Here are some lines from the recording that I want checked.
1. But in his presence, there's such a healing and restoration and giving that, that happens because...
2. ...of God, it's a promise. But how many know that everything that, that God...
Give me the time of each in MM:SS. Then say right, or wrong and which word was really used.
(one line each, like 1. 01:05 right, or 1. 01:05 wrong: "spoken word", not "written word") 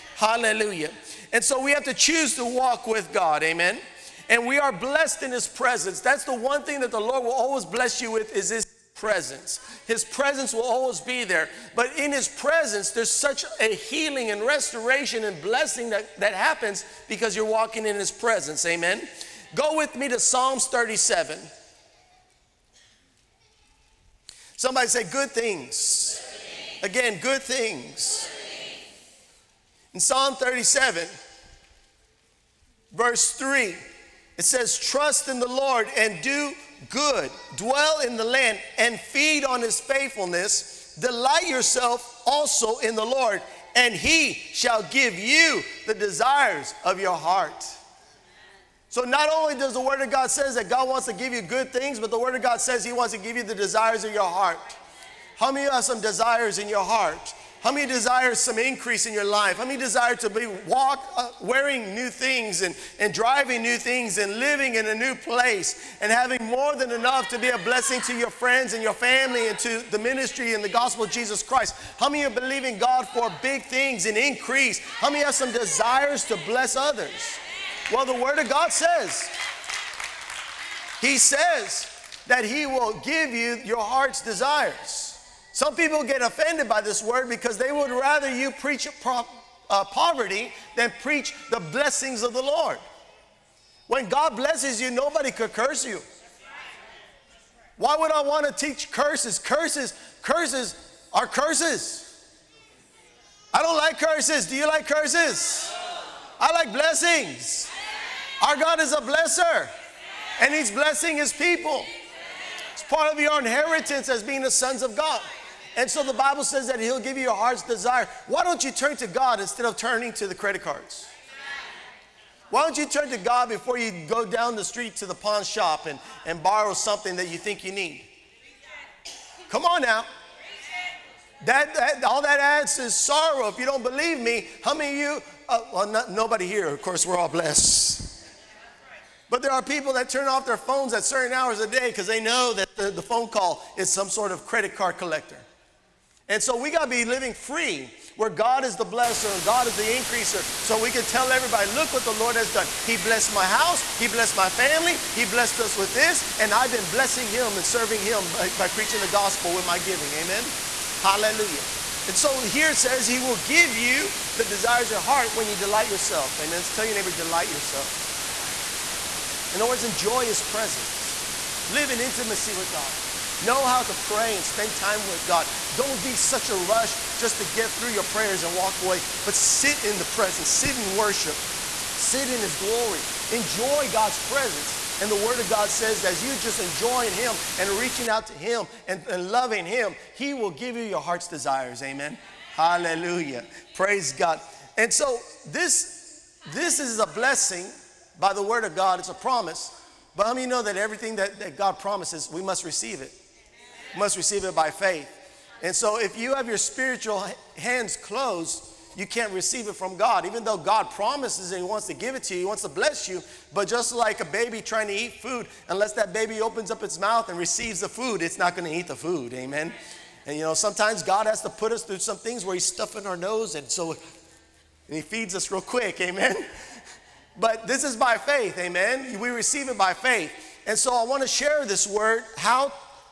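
1. 00:11 wrong: "blessing", not "giving"
2. 03:18 right.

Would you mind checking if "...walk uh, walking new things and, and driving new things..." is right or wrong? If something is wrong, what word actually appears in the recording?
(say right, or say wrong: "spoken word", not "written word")
wrong: "wearing", not "walking".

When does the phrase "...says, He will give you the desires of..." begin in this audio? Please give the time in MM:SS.
02:42.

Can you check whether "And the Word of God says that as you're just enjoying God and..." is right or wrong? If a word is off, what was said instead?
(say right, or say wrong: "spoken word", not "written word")
wrong: "Him", not "God".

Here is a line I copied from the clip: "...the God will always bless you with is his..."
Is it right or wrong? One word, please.
wrong.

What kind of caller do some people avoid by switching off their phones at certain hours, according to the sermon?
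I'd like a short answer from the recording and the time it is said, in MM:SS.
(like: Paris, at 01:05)
Credit card collector, at 02:24.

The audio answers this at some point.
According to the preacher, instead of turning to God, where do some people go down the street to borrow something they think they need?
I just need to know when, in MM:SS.
02:05.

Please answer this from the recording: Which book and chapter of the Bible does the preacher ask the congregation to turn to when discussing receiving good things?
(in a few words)
Psalms 37.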